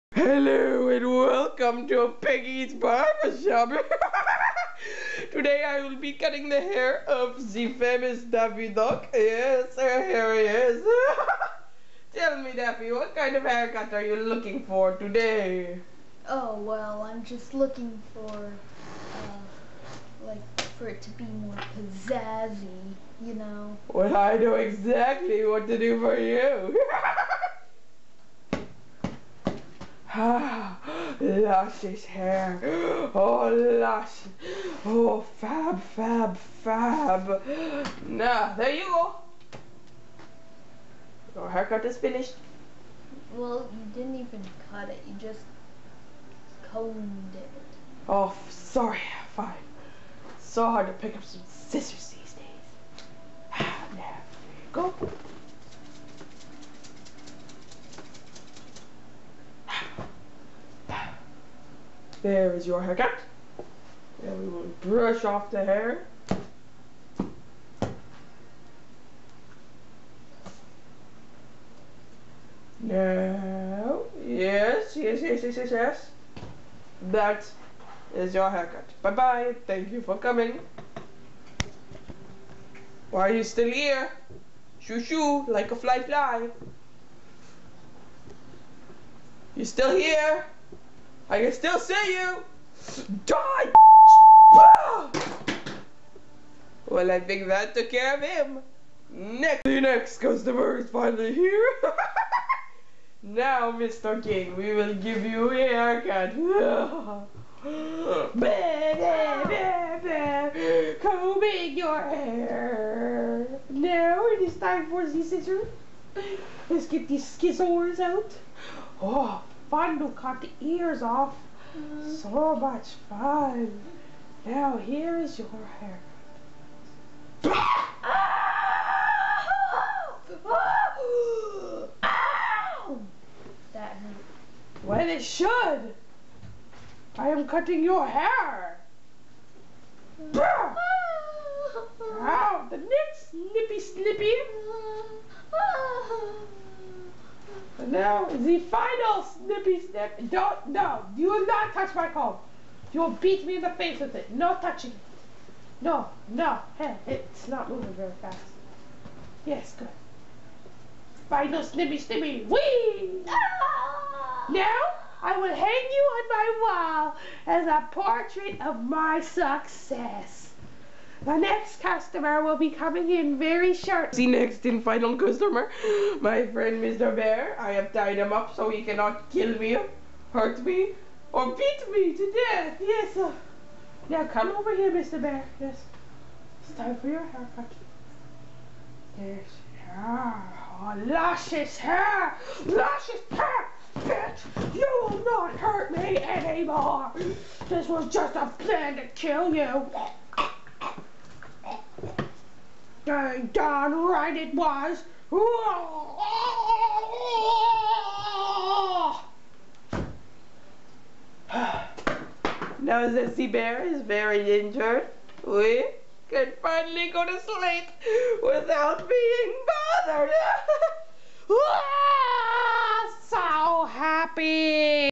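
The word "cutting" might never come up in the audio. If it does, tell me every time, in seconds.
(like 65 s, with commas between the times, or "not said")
6 s, 137 s.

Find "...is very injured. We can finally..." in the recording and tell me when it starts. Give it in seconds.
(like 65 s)
213 s.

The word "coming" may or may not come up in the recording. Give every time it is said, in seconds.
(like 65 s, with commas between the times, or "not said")
80 s, 172 s.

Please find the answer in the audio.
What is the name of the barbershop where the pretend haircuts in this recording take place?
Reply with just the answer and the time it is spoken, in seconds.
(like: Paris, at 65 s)
Piggy's Barbershop, at 2 s.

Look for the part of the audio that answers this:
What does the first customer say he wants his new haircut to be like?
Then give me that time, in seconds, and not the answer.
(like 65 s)
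21 s.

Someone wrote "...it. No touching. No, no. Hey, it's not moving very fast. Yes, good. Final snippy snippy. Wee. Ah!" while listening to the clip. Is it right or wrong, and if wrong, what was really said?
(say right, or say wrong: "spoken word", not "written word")
right.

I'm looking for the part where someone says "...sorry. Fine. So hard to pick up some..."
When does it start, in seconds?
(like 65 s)
48 s.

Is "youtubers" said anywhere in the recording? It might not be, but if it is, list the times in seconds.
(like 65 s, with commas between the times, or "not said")
not said.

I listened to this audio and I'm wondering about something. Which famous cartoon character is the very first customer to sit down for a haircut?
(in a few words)
Daffy Duck.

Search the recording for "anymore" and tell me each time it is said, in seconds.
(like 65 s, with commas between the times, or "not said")
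196 s.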